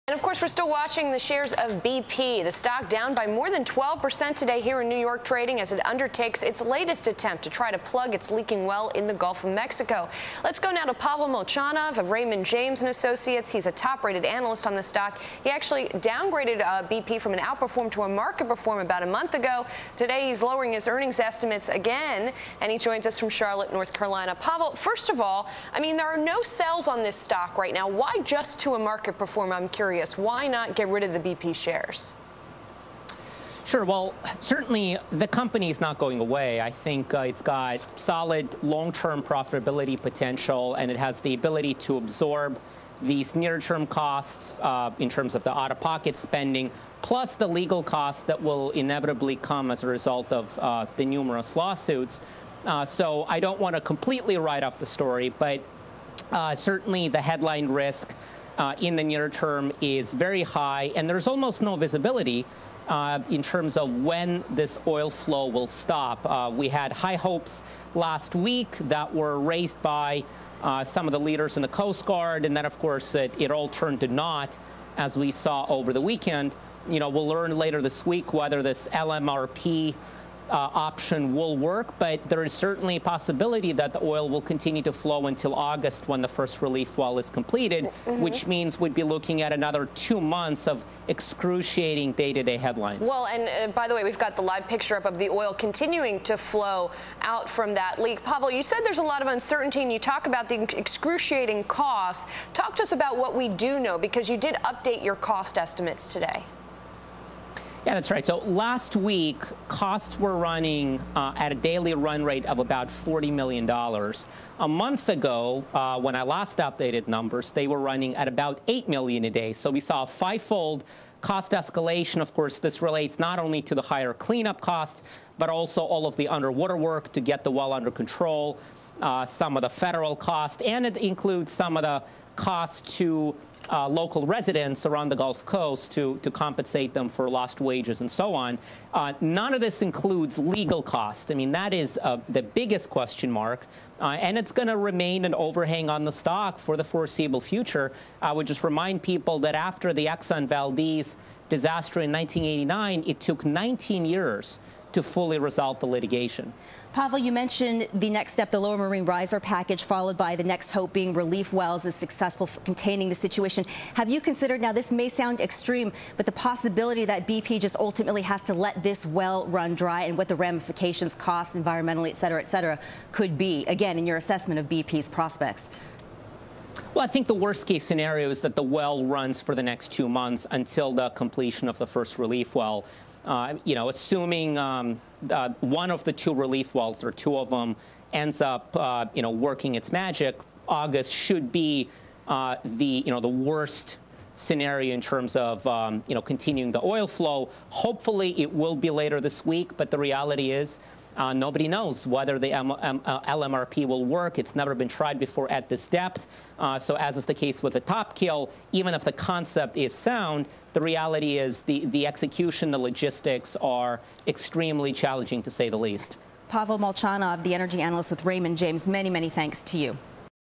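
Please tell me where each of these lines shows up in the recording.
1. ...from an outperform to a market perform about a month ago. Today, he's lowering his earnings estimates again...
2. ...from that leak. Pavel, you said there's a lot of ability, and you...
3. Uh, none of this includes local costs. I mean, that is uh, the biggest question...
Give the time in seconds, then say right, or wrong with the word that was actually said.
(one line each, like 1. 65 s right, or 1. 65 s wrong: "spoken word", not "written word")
1. 17 s right
2. 97 s wrong: "uncertainty", not "ability"
3. 138 s wrong: "legal", not "local".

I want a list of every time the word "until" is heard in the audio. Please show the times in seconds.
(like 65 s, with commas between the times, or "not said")
85 s, 180 s.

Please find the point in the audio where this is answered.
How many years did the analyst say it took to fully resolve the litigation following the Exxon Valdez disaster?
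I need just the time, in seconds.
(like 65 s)
153 s.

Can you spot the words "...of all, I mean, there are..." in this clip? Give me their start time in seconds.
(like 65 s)
25 s.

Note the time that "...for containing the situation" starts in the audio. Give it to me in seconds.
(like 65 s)
162 s.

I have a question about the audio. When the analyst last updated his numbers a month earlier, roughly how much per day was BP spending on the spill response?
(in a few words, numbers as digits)
$8 million.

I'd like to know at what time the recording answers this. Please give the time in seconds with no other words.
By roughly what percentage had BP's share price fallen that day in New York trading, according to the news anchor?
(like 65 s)
3 s.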